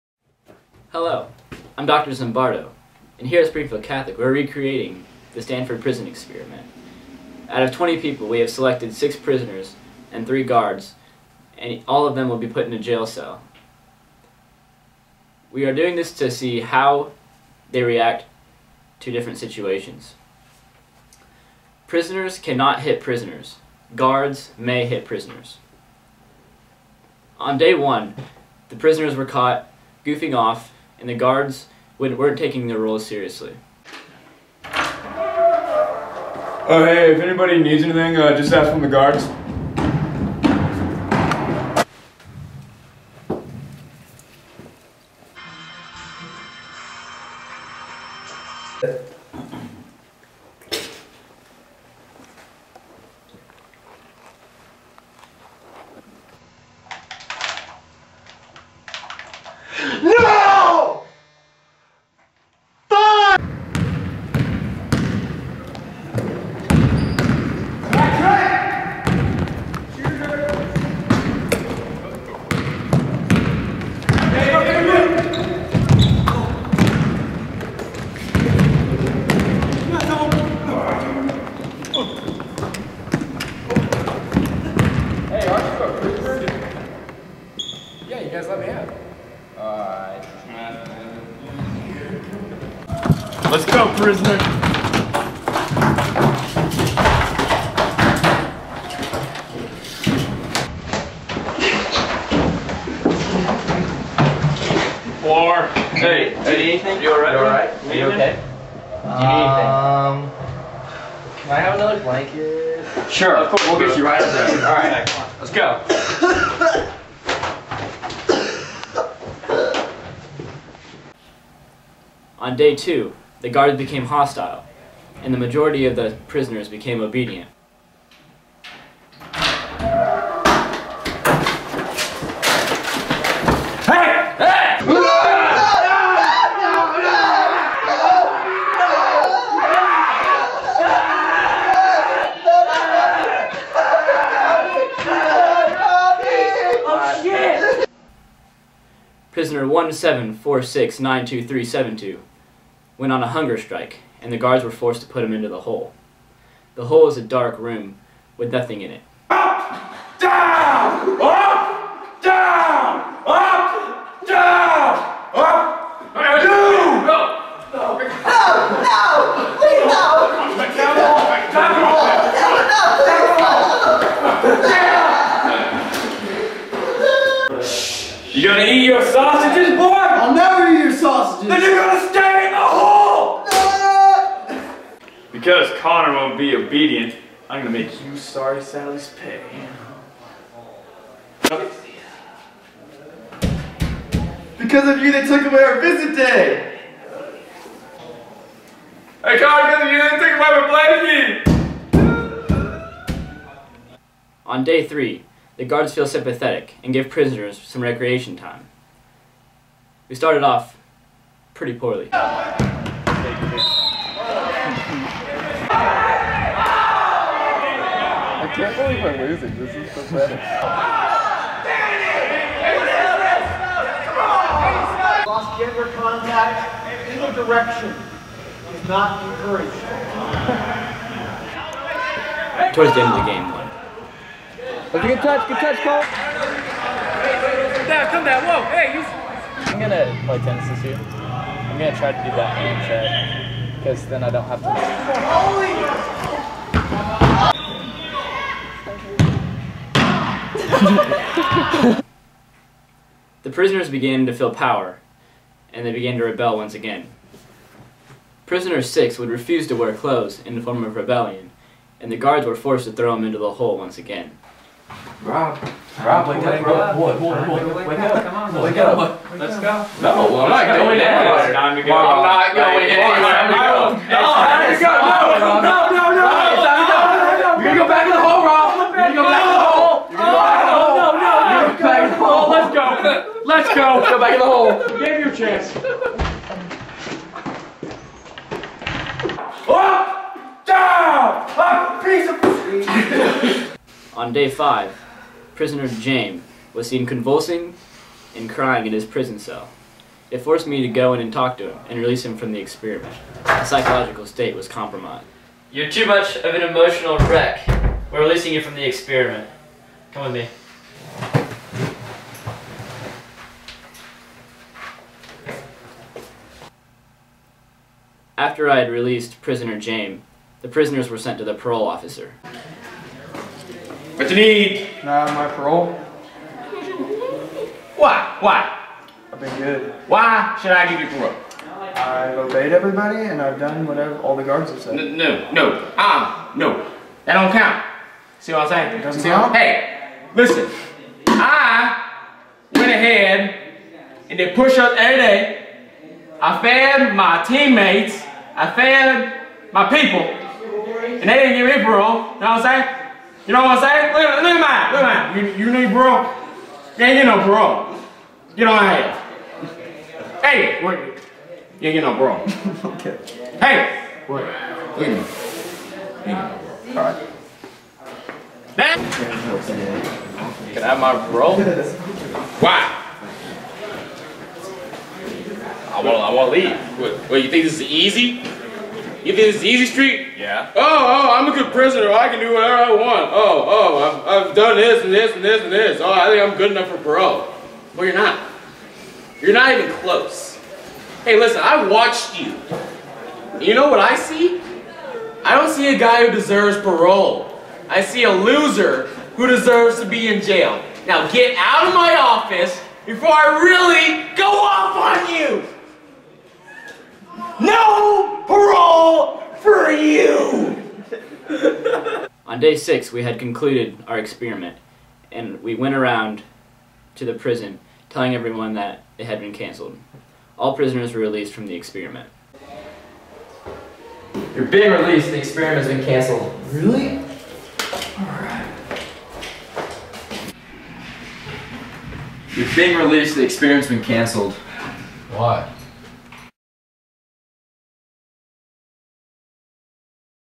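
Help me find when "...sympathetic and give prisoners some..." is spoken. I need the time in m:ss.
3:26.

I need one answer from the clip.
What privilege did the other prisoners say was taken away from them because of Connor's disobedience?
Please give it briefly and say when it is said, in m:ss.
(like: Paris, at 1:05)
Visit day, at 3:15.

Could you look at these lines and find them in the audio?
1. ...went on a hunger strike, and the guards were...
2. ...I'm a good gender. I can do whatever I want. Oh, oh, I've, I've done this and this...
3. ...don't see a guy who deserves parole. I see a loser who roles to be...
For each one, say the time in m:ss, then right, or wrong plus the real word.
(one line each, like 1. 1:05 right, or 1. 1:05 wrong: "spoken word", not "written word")
1. 2:33 right
2. 6:21 wrong: "prisoner", not "gender"
3. 6:35 wrong: "deserves", not "roles".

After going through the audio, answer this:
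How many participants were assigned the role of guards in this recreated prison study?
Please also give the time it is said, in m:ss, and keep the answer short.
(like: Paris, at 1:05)
3, at 0:10.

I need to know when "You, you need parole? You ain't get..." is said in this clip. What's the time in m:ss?
5:55.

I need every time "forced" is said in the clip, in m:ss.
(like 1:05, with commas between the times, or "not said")
2:34, 4:22, 5:00.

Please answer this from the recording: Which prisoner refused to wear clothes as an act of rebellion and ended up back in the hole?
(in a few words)
Prisoner 6.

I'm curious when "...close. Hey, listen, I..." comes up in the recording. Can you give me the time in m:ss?
6:29.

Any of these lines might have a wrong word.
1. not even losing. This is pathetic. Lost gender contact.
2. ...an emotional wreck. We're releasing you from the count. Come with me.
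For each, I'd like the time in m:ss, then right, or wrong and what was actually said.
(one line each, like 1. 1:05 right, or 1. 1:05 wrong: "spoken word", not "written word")
1. 3:38 right
2. 5:06 wrong: "experiment", not "count".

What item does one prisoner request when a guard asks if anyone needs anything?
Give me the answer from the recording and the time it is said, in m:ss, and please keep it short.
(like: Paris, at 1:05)
Another blanket, at 1:51.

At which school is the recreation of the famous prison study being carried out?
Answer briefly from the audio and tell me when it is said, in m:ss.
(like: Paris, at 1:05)
Springfield Catholic, at 0:03.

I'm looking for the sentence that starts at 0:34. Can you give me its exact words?
Oh, hey, if anybody needs anything, uh, just ask from the guards.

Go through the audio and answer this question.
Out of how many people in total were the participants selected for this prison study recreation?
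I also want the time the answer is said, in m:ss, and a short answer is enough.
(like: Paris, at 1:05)
20, at 0:07.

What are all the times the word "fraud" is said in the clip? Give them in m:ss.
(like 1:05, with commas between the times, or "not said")
not said.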